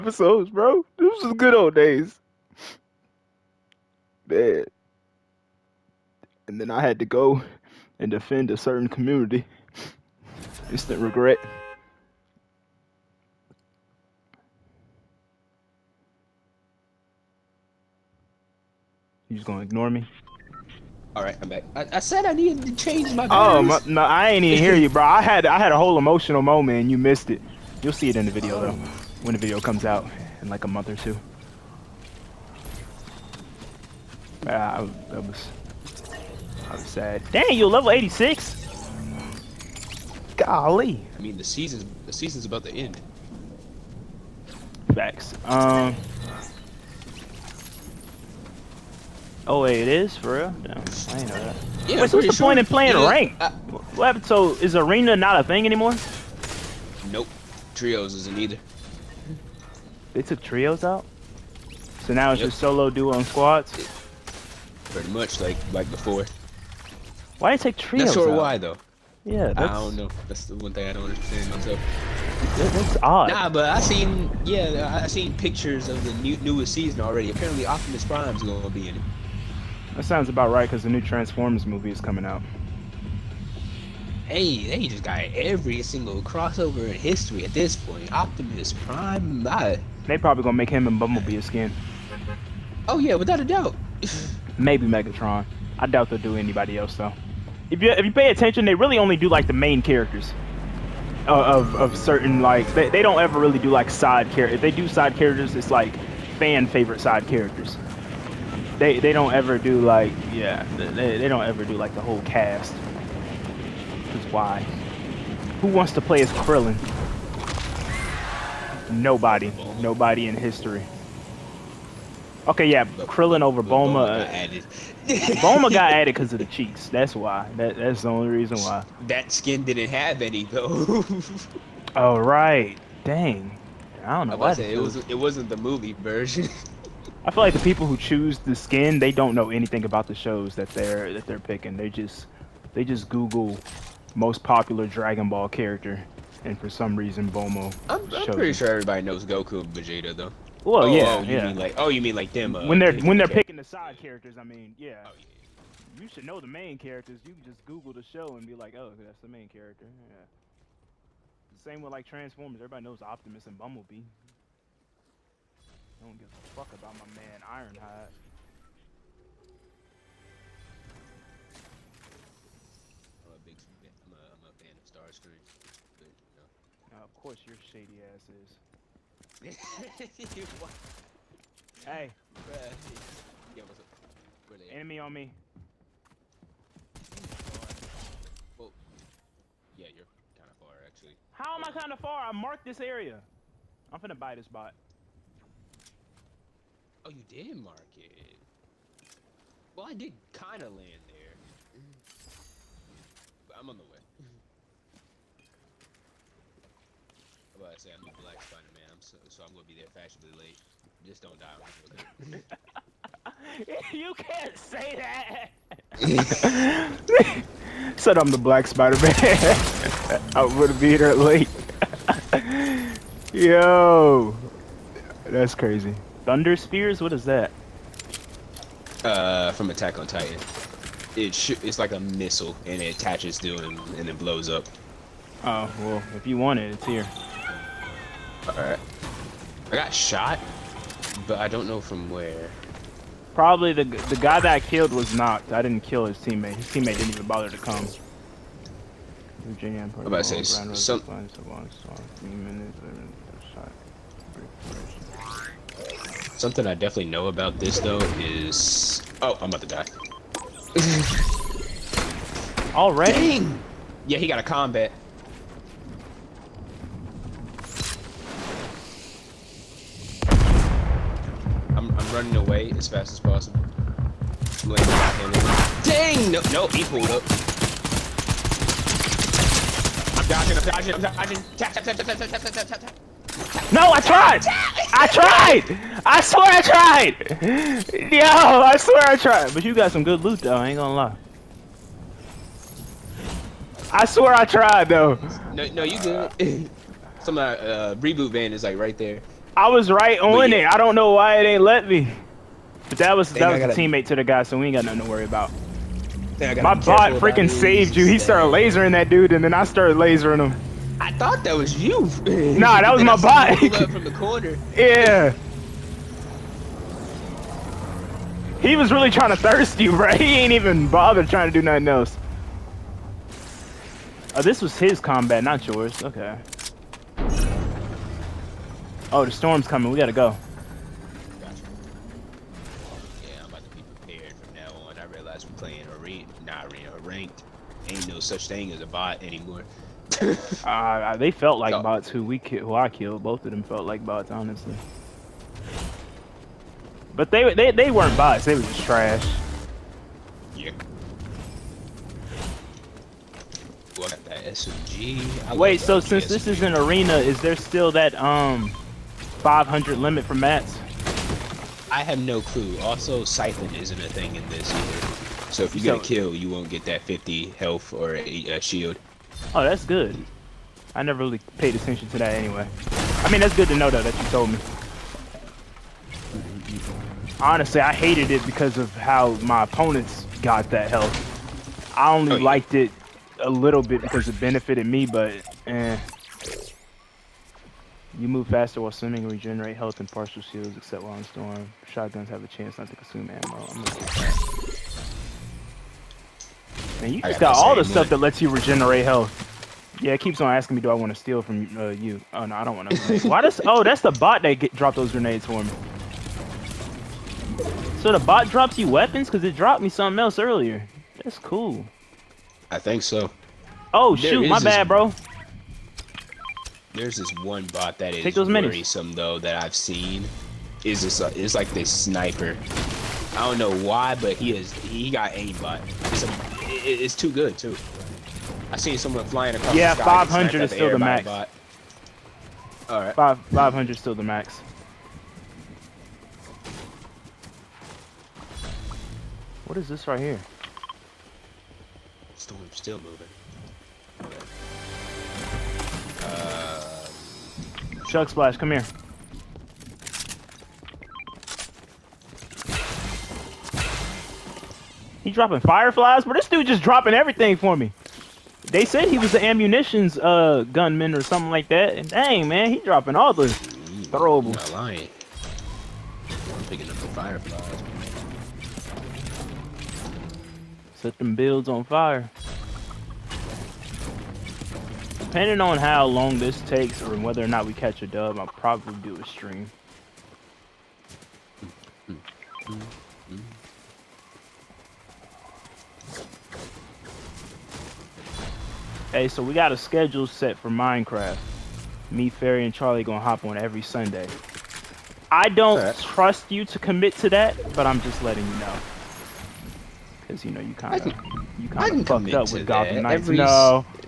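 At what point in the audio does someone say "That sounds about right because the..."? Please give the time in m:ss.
1:19.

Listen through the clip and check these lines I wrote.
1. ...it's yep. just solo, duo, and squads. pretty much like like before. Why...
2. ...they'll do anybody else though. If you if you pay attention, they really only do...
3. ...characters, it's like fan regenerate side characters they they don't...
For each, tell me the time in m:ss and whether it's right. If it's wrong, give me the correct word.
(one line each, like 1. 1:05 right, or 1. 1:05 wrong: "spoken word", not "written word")
1. 1:02 right
2. 1:36 right
3. 1:45 wrong: "favorite", not "regenerate".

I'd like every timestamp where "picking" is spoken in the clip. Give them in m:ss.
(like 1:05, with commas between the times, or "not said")
2:21, 2:33, 7:46.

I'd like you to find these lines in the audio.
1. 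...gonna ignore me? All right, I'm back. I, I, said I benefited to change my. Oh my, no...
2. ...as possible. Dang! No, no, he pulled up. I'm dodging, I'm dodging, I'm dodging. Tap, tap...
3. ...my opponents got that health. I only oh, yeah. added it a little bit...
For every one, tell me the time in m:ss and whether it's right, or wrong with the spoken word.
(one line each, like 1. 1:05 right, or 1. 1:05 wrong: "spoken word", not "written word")
1. 0:19 wrong: "needed", not "benefited"
2. 4:33 right
3. 6:19 wrong: "liked", not "added".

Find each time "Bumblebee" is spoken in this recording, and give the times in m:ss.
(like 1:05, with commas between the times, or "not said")
1:30, 2:43.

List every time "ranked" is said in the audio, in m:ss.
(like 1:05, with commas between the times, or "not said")
0:53, 5:37.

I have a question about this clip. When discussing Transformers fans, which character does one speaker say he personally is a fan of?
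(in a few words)
Starscream.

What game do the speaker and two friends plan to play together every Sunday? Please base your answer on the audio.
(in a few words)
Minecraft.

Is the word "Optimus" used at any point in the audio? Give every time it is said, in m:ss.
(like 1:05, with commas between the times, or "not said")
1:17, 1:28, 2:43.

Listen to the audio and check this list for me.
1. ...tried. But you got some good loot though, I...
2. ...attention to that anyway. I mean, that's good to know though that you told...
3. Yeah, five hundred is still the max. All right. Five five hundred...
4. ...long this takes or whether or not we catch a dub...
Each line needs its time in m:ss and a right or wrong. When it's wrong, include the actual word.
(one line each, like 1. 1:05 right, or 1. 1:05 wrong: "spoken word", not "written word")
1. 4:49 right
2. 6:11 right
3. 7:09 right
4. 7:56 right.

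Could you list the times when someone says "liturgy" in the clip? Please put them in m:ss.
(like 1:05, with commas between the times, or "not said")
not said.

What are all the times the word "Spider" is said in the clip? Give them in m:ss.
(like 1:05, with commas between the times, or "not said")
3:28, 3:38.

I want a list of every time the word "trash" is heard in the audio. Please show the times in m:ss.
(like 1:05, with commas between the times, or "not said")
5:48.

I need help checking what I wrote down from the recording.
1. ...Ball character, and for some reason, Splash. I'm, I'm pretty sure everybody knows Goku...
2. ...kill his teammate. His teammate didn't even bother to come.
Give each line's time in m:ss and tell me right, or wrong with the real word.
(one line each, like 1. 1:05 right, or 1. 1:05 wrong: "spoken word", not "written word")
1. 2:25 wrong: "Bulma", not "Splash"
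2. 4:05 right.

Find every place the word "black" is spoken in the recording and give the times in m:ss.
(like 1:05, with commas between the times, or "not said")
3:28, 3:38.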